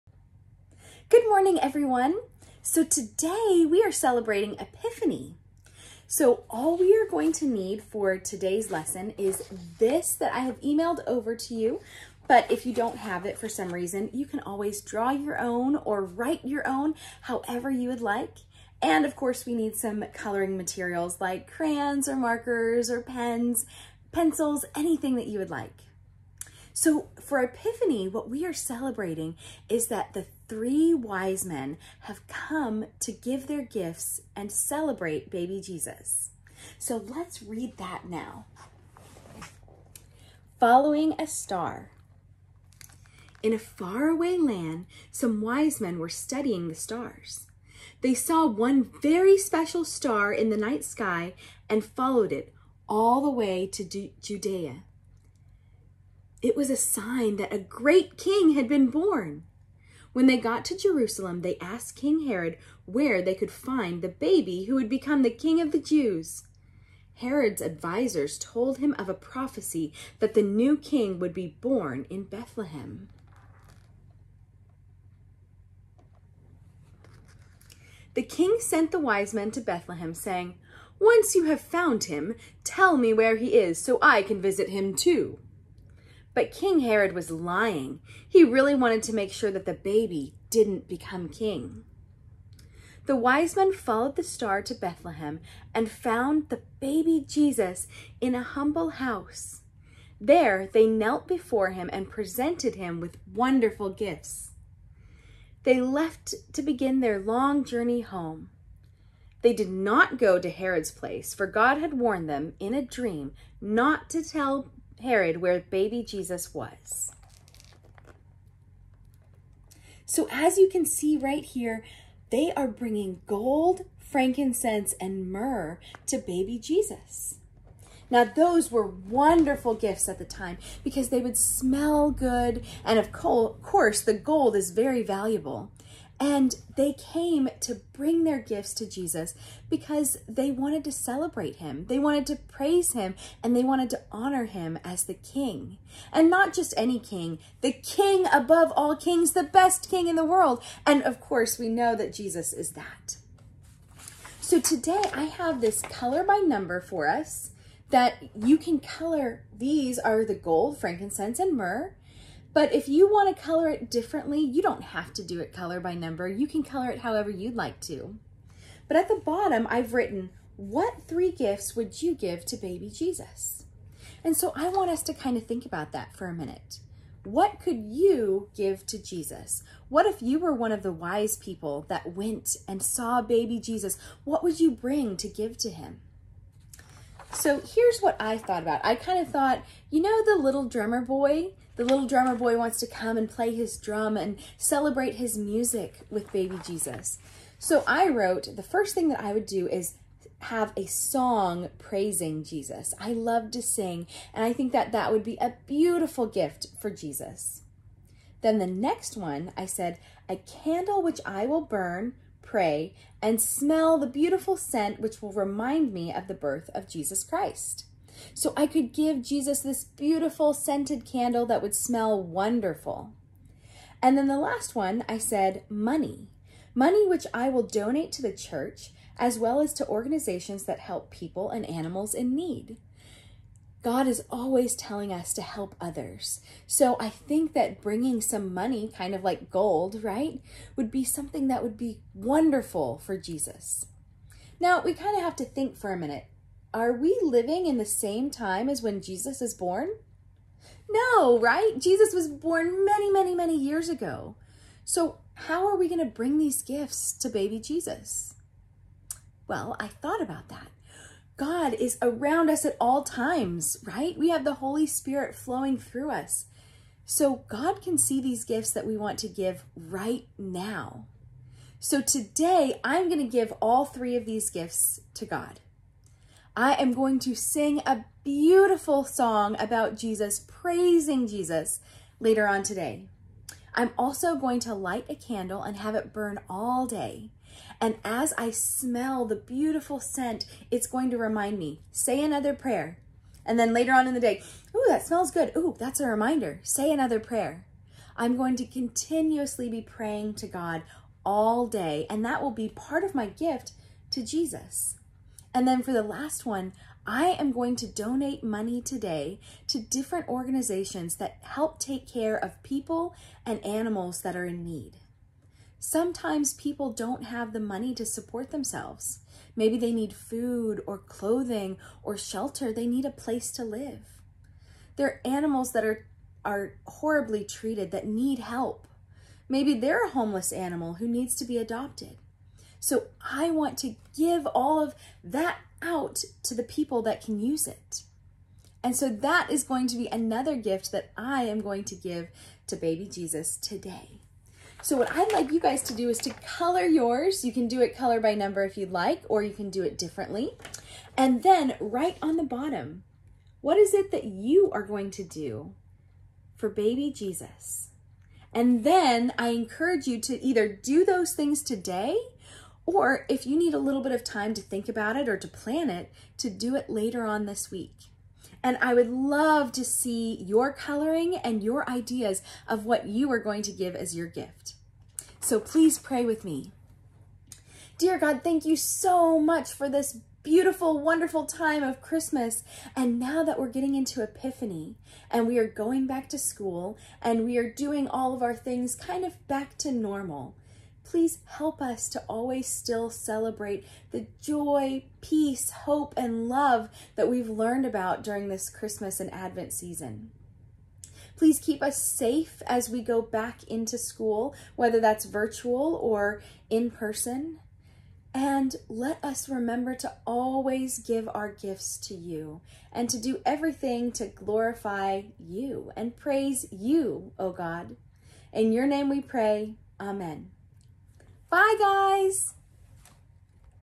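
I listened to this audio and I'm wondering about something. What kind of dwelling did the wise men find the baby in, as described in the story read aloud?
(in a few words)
a humble house.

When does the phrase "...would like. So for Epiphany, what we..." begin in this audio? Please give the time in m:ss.
0:25.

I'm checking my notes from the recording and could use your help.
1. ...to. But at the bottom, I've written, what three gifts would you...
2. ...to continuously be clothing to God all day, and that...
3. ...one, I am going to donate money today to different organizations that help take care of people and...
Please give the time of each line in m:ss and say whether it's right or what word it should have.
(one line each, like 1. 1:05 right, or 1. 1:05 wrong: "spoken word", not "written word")
1. 2:47 right
2. 4:58 wrong: "praying", not "clothing"
3. 5:06 right.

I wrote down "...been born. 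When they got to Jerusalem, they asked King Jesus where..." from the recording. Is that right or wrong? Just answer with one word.
wrong.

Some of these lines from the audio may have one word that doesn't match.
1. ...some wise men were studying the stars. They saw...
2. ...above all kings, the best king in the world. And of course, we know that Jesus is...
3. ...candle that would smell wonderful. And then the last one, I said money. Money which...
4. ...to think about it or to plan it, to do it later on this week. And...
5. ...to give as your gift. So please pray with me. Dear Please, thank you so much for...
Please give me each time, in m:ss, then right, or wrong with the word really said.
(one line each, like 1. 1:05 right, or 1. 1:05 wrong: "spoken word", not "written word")
1. 0:45 right
2. 2:28 right
3. 3:41 right
4. 6:04 right
5. 6:13 wrong: "God", not "Please".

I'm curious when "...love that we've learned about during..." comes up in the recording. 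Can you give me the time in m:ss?
6:36.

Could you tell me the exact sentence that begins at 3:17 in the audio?
So I wrote, the first thing that I would do is have a song praising Jesus.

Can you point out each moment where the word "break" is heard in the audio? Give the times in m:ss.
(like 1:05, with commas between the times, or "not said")
not said.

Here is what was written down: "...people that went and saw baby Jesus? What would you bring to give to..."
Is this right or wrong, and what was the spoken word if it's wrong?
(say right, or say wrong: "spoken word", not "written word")
right.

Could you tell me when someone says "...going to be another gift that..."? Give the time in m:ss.
5:39.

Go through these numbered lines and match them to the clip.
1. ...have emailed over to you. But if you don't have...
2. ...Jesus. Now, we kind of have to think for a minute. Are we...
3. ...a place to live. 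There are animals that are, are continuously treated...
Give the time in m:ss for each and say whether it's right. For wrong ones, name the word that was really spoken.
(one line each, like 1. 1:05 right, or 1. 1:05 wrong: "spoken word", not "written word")
1. 0:10 right
2. 4:03 right
3. 5:23 wrong: "horribly", not "continuously".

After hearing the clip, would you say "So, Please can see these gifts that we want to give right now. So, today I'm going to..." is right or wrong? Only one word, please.
wrong.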